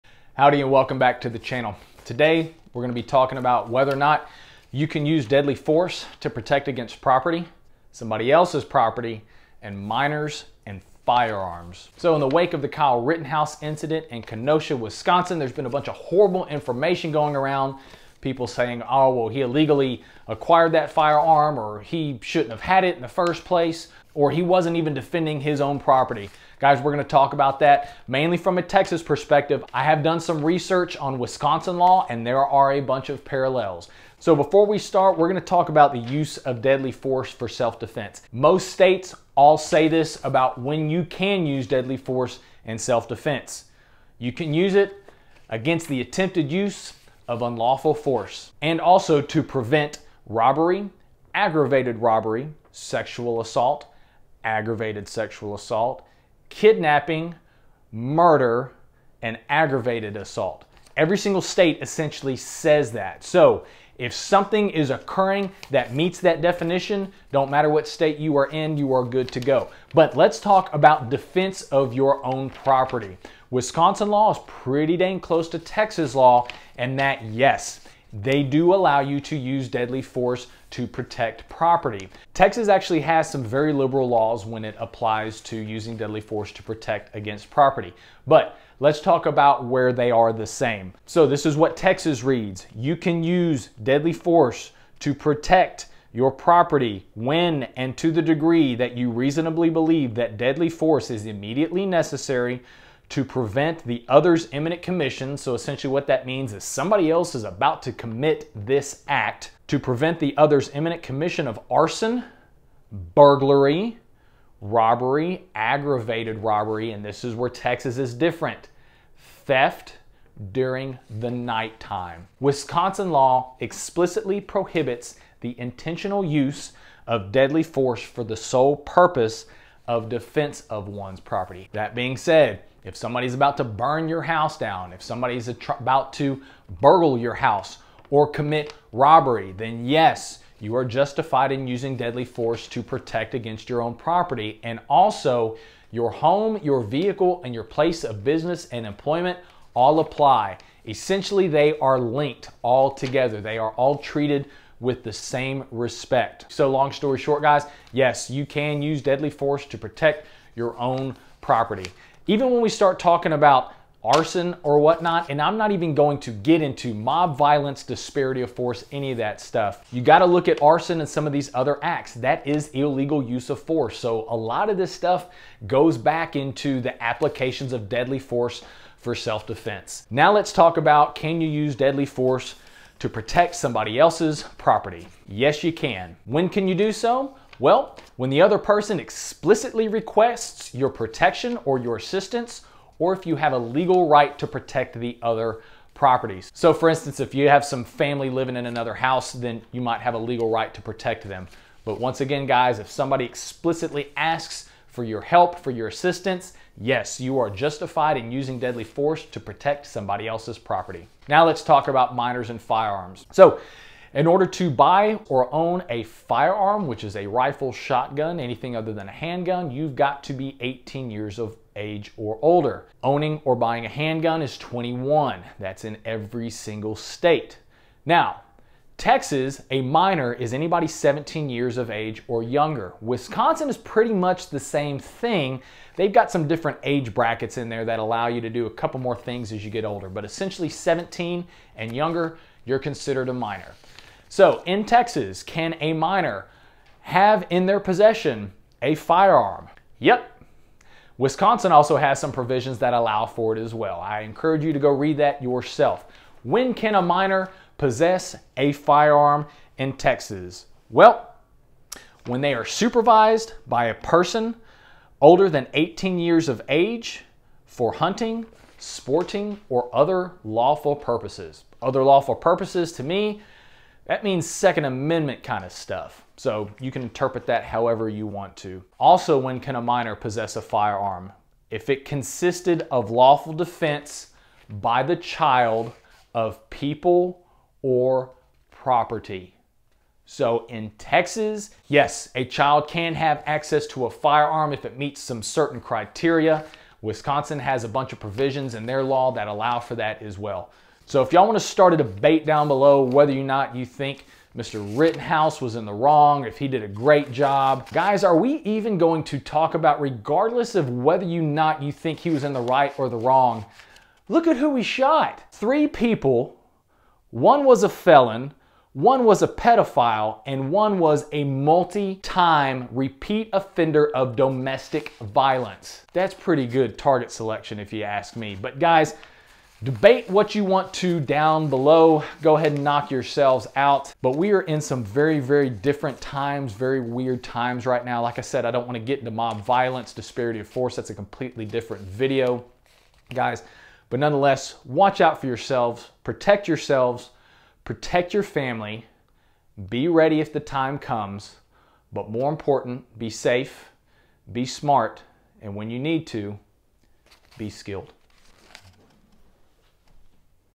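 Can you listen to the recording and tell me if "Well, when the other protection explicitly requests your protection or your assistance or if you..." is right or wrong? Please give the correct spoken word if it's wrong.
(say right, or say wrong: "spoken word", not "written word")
wrong: "person", not "protection".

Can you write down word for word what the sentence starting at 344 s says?
But nonetheless, watch out for yourselves, protect yourselves, protect your family, be ready if the time comes.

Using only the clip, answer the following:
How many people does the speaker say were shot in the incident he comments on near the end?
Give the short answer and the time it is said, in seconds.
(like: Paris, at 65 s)
3, at 315 s.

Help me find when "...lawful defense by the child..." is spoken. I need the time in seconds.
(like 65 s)
283 s.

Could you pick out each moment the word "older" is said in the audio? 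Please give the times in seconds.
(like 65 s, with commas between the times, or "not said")
222 s, 239 s, 265 s.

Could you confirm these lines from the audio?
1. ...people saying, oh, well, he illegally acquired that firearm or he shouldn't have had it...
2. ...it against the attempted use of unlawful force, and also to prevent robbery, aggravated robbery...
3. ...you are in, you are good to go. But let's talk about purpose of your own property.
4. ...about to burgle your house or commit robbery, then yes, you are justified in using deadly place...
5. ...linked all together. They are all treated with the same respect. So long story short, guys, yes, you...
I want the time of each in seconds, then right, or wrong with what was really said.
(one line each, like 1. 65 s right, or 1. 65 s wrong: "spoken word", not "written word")
1. 18 s right
2. 44 s right
3. 68 s wrong: "defense", not "purpose"
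4. 135 s wrong: "force", not "place"
5. 151 s right.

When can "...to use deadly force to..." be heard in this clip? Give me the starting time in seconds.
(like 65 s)
79 s.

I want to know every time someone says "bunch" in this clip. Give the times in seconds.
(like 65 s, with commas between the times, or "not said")
15 s, 32 s, 297 s.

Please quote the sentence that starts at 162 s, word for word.
Even when we start talking about arson or whatnot.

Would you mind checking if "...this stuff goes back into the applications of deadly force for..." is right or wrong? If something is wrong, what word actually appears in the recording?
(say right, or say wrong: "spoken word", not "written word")
right.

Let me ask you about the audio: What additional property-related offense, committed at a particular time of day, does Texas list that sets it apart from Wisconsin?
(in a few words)
theft during the nighttime.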